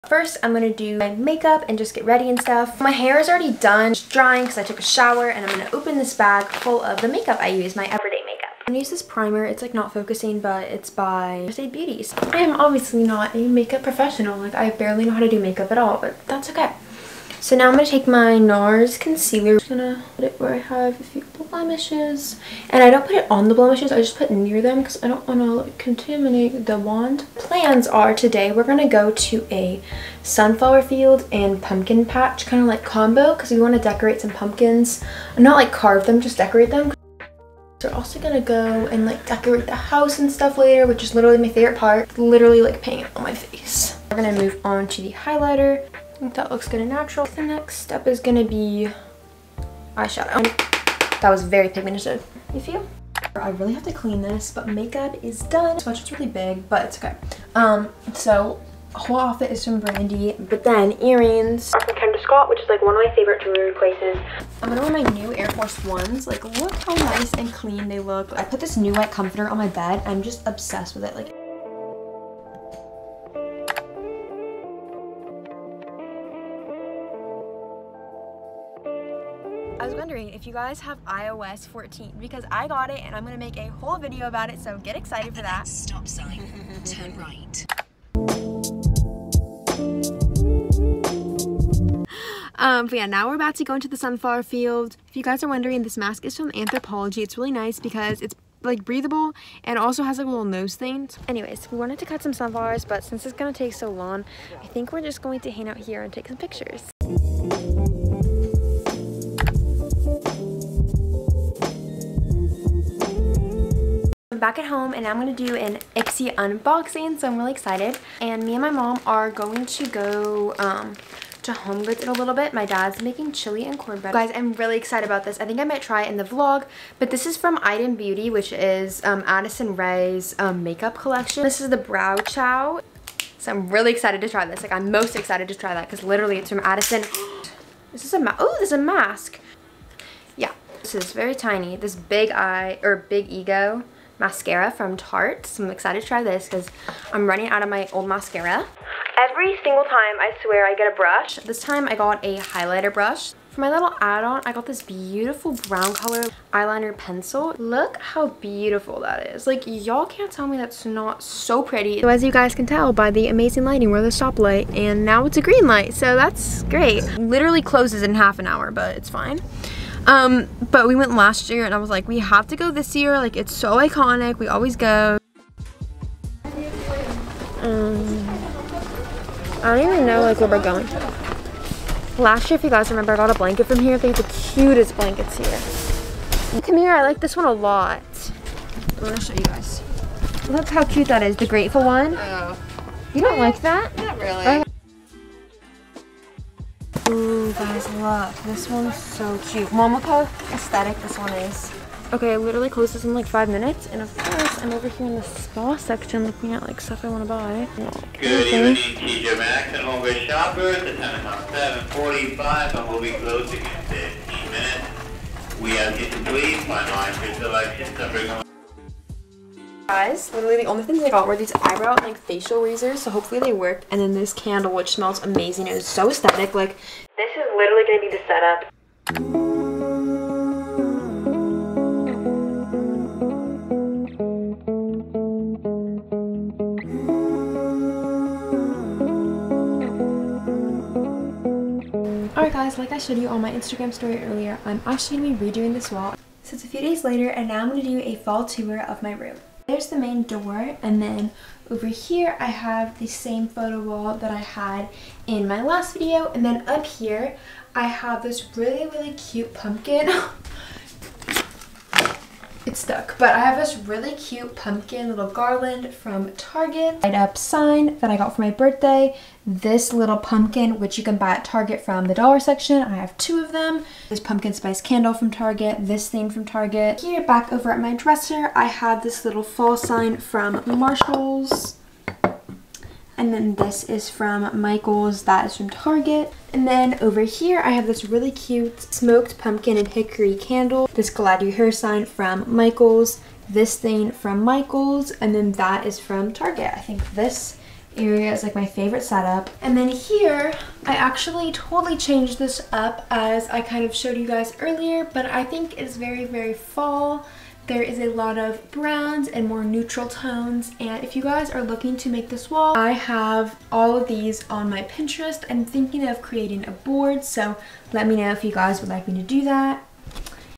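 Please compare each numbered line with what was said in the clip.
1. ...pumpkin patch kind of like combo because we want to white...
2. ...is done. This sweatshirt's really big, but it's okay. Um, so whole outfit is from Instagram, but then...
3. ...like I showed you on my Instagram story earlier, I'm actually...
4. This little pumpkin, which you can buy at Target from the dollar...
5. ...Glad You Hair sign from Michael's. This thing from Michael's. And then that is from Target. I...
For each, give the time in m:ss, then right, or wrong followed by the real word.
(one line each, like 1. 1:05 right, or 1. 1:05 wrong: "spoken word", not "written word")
1. 0:31 wrong: "decorate", not "white"
2. 0:55 wrong: "Brandy", not "Instagram"
3. 4:02 right
4. 4:29 right
5. 4:51 right.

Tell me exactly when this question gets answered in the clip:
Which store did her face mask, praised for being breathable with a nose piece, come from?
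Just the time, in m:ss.
1:36.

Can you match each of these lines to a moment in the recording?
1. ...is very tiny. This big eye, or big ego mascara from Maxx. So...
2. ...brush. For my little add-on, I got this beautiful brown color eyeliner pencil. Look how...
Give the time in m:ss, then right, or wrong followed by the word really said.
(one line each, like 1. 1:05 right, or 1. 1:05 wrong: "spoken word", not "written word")
1. 2:21 wrong: "Tarte", not "Maxx"
2. 2:32 right.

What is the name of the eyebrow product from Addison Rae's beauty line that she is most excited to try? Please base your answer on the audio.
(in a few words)
Brow Chow.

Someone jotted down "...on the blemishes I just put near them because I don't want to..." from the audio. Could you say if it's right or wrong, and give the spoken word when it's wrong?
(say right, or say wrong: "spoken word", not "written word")
right.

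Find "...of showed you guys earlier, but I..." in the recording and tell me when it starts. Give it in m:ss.
5:03.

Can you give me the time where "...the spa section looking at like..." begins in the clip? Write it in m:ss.
3:25.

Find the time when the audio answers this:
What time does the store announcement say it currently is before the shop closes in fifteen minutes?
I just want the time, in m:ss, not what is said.
3:31.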